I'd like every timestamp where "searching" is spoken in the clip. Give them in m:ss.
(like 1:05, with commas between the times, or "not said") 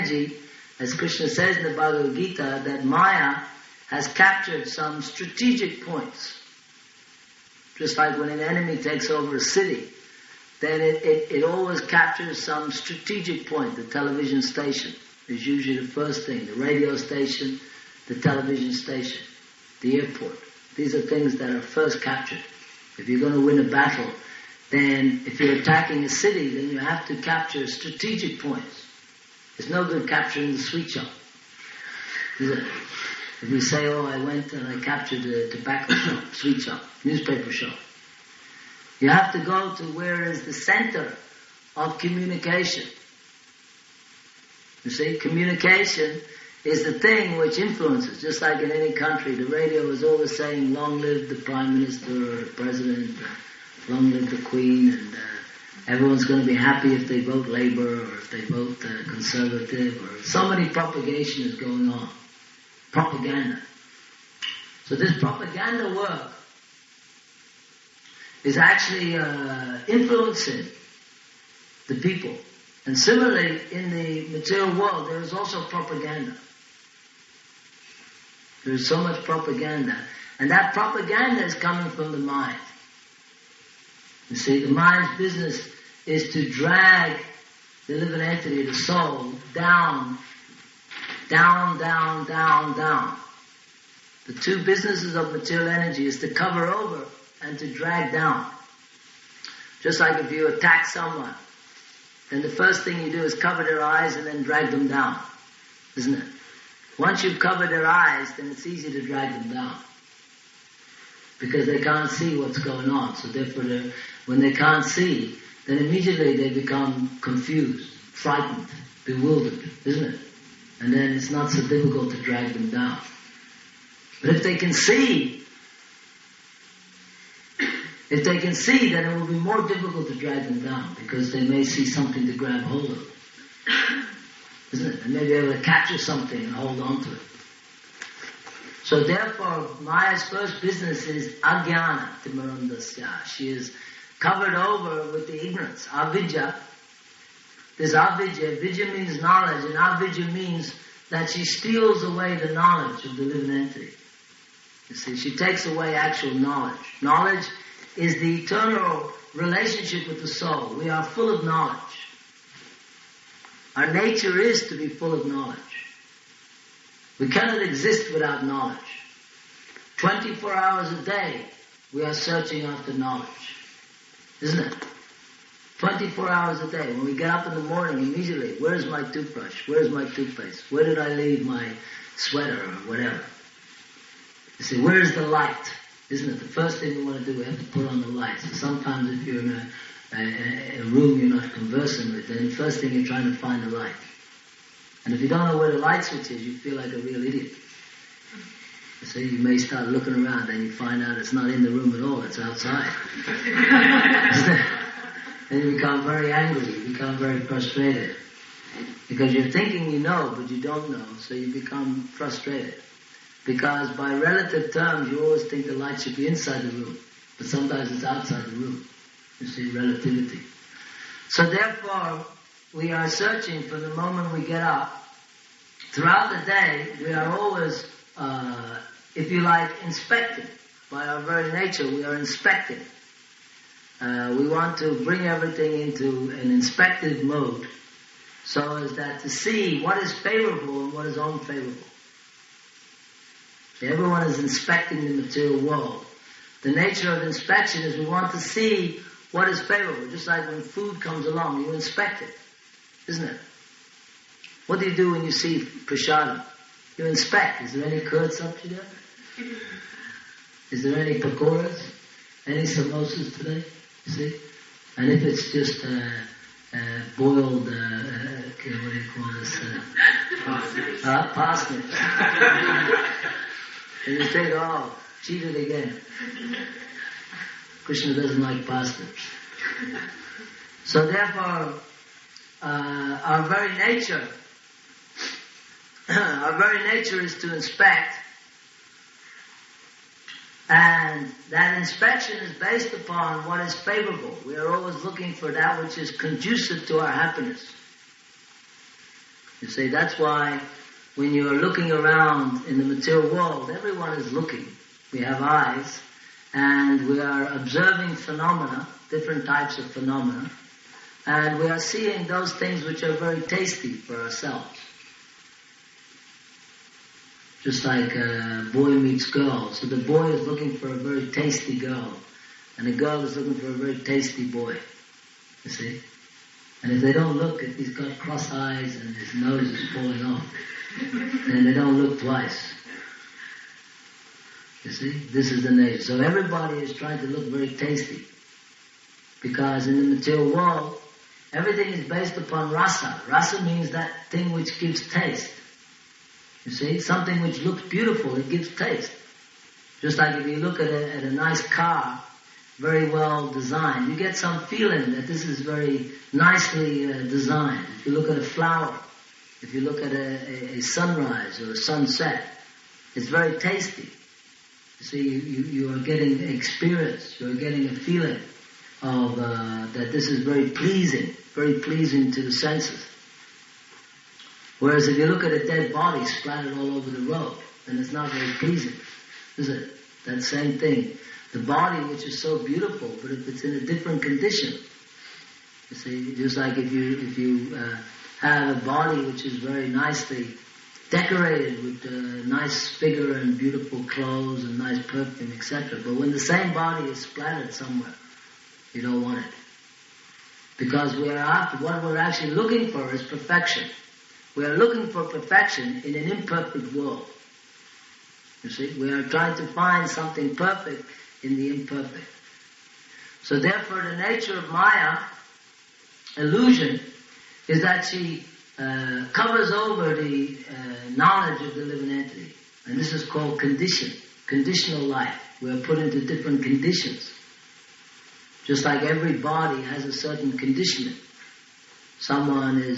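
2:52, 3:43.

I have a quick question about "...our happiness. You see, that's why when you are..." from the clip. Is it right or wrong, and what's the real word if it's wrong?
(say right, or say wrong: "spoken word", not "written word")
right.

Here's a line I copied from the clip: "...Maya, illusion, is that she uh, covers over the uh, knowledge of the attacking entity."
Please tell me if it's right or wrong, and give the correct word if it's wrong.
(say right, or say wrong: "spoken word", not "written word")
wrong: "living", not "attacking".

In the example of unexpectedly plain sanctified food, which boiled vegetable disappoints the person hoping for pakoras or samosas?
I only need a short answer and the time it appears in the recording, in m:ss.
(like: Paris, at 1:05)
Parsnips, at 4:30.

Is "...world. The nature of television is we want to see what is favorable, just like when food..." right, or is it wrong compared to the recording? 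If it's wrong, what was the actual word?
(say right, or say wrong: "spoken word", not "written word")
wrong: "inspection", not "television".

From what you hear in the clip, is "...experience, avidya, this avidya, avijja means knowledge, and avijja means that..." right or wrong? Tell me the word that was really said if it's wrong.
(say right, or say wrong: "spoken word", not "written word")
wrong: "ignorance", not "experience".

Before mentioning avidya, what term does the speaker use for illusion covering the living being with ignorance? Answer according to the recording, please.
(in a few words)
Agyana.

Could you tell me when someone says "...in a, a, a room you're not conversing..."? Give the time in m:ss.
3:09.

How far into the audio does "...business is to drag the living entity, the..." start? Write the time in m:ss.
1:25.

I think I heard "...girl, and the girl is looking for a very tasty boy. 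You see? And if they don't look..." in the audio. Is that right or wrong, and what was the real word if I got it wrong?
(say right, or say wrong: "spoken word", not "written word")
right.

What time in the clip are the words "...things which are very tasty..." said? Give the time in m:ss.
5:12.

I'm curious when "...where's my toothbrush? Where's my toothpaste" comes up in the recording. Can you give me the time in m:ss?
2:58.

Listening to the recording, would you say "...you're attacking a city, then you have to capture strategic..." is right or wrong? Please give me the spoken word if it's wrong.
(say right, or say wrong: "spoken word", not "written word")
right.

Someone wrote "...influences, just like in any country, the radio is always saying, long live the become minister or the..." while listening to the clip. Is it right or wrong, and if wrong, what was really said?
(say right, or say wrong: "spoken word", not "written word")
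wrong: "prime", not "become".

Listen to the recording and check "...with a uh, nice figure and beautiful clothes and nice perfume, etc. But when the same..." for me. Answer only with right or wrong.
right.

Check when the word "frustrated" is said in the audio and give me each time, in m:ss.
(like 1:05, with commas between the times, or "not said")
3:27, 3:32.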